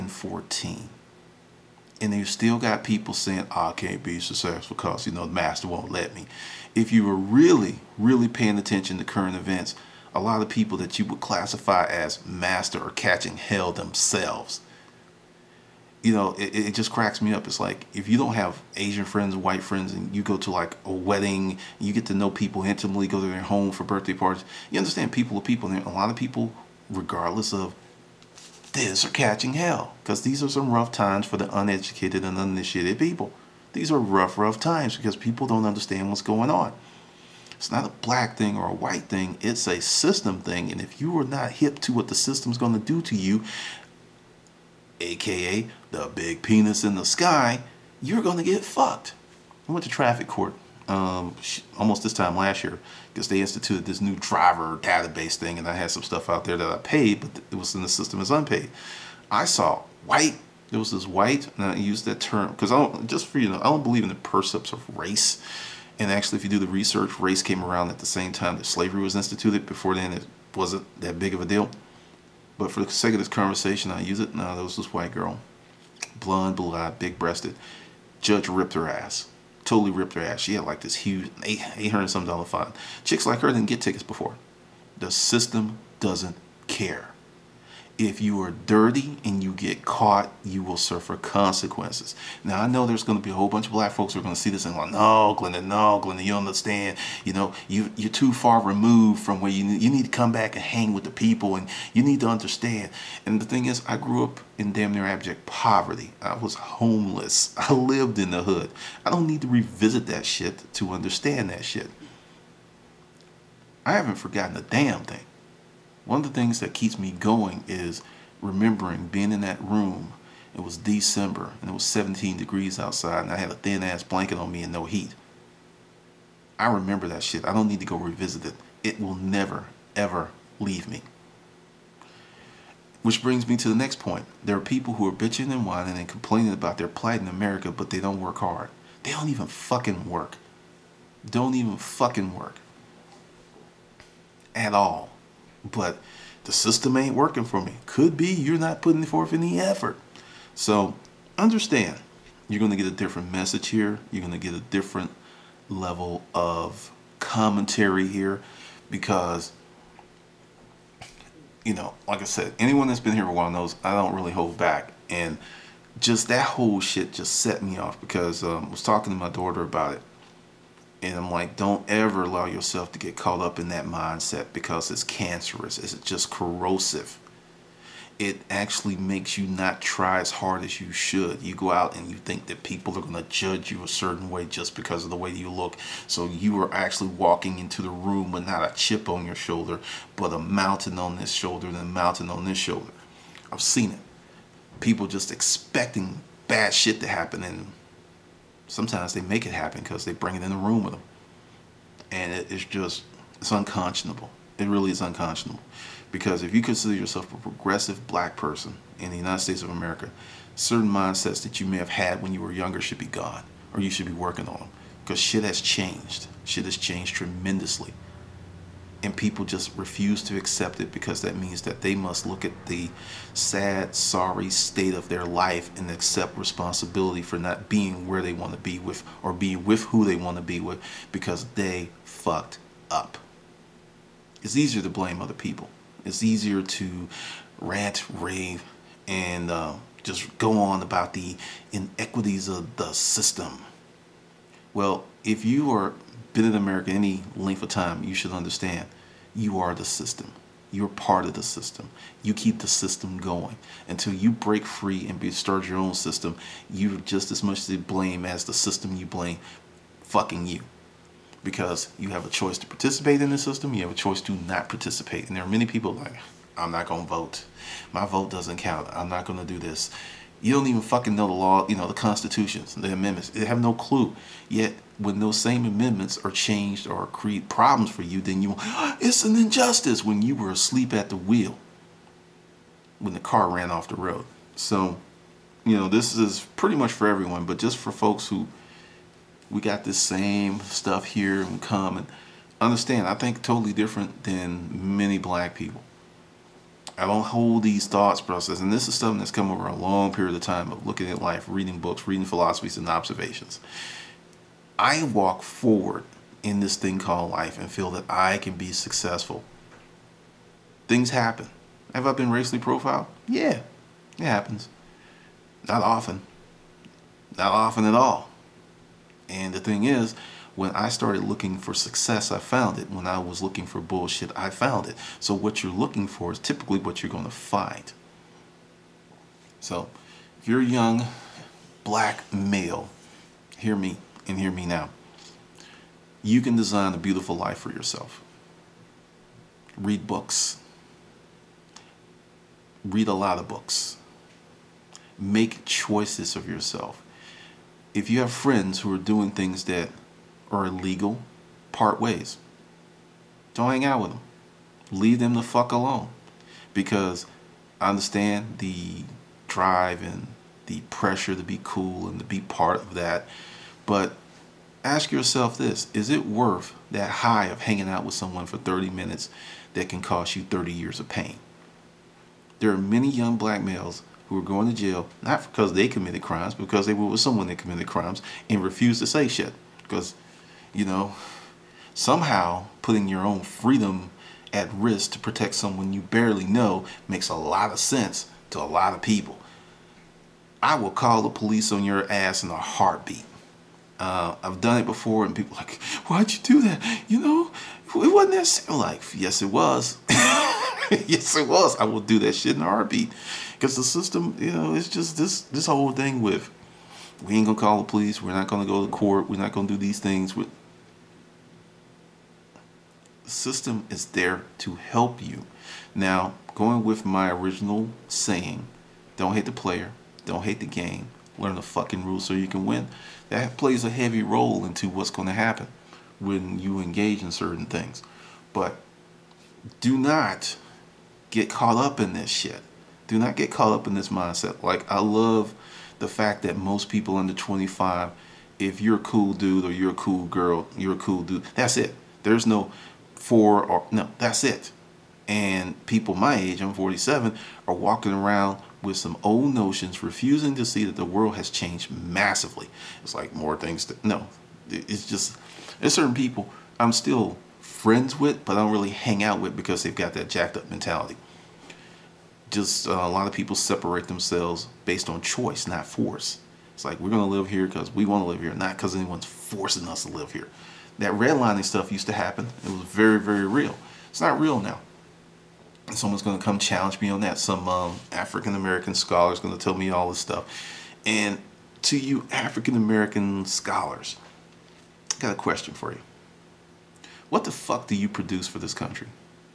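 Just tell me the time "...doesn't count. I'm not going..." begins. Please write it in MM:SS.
04:28.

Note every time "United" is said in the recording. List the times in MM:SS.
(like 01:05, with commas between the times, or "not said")
03:29.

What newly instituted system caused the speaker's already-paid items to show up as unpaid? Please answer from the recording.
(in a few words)
Driver database.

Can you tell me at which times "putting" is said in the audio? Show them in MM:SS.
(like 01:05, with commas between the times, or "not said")
02:28, 06:22.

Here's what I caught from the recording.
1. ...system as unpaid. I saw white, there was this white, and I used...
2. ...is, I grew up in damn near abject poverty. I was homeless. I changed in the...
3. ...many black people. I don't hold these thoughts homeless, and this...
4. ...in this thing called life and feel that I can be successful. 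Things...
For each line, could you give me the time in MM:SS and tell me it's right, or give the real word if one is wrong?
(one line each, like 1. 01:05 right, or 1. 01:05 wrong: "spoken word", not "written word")
1. 00:57 right
2. 01:43 wrong: "lived", not "changed"
3. 04:54 wrong: "process", not "homeless"
4. 05:06 right.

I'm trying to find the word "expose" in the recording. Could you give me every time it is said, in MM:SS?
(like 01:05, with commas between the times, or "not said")
not said.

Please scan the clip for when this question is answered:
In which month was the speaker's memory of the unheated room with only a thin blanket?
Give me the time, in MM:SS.
02:00.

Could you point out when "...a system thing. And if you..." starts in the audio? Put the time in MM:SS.
00:39.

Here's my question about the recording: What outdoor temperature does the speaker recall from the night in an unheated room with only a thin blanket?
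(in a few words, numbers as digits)
17 degrees.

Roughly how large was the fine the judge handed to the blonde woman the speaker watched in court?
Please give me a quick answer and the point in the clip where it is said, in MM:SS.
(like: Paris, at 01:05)
800-some dollars, at 01:21.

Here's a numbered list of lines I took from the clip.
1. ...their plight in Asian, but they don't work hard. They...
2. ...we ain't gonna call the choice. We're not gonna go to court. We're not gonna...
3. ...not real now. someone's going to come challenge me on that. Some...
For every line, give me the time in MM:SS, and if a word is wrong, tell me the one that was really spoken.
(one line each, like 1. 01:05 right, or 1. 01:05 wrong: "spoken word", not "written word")
1. 02:16 wrong: "America", not "Asian"
2. 06:47 wrong: "police", not "choice"
3. 07:54 right.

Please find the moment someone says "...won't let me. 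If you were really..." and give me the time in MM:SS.
00:05.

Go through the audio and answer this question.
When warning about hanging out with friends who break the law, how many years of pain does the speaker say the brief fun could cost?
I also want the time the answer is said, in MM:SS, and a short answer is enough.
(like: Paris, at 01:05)
30 years, at 06:10.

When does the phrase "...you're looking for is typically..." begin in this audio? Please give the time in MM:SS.
05:25.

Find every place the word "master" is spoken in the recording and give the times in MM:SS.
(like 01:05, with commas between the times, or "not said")
00:05, 00:12.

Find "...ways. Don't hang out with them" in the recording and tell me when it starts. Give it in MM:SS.
05:51.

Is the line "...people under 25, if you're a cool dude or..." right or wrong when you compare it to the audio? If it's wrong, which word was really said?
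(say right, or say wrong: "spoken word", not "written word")
right.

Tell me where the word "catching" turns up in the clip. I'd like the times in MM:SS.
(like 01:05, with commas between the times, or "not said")
00:12, 00:29.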